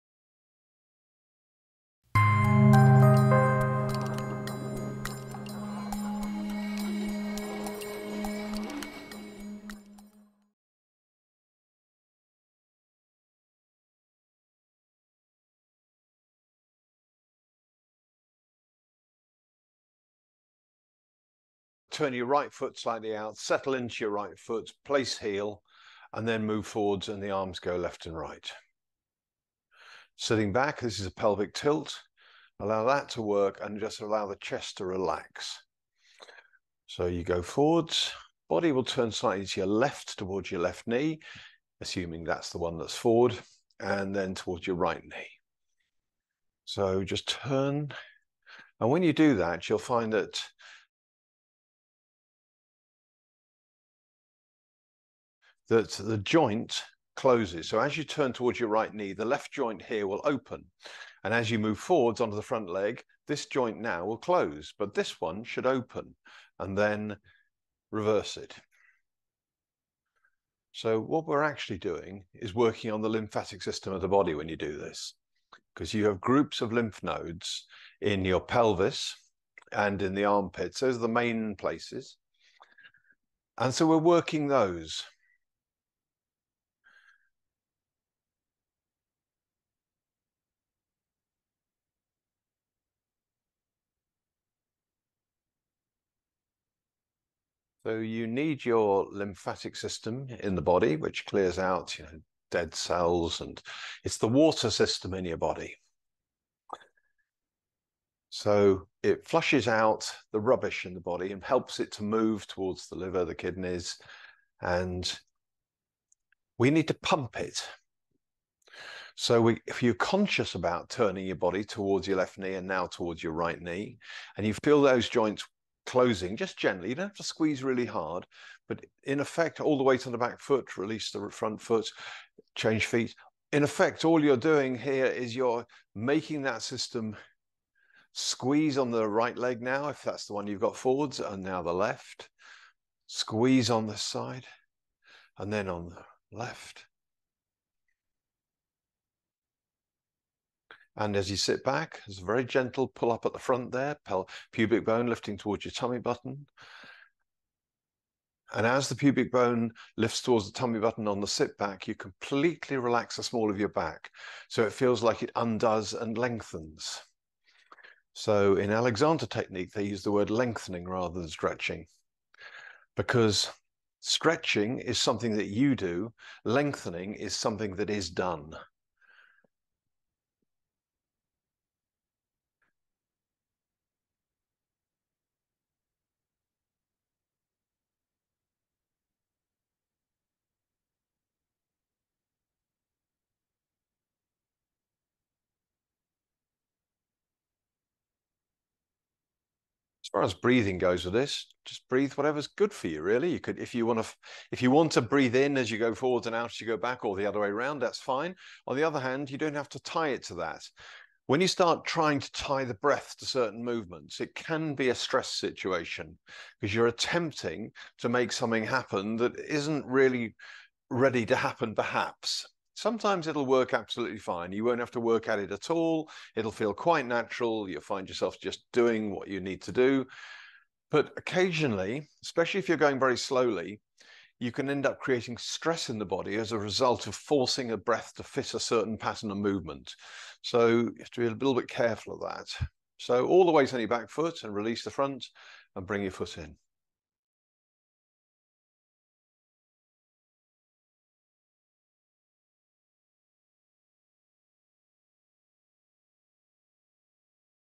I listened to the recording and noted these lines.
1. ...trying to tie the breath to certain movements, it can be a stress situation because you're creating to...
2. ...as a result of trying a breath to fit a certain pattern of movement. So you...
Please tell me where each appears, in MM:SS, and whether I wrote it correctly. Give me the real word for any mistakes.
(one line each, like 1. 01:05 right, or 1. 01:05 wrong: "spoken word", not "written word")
1. 03:31 wrong: "attempting", not "creating"
2. 03:56 wrong: "forcing", not "trying".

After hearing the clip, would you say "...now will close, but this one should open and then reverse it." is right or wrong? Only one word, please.
right.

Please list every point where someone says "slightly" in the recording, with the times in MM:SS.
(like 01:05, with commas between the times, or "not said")
00:22, 00:39.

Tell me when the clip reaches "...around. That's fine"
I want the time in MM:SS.
03:27.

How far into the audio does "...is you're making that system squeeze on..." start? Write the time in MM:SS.
02:15.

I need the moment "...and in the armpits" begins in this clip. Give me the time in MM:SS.
01:19.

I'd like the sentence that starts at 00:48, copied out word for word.
And when you do that, you'll find that that the joint closes.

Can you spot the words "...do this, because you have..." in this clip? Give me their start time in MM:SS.
01:14.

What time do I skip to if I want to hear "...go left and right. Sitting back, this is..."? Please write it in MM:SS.
00:27.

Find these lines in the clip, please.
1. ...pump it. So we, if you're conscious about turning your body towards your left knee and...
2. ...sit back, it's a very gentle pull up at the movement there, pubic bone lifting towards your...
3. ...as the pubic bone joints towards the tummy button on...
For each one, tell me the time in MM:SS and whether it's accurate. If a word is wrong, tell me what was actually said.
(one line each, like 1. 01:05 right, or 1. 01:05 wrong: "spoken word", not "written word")
1. 01:56 right
2. 02:31 wrong: "front", not "movement"
3. 02:38 wrong: "lifts", not "joints".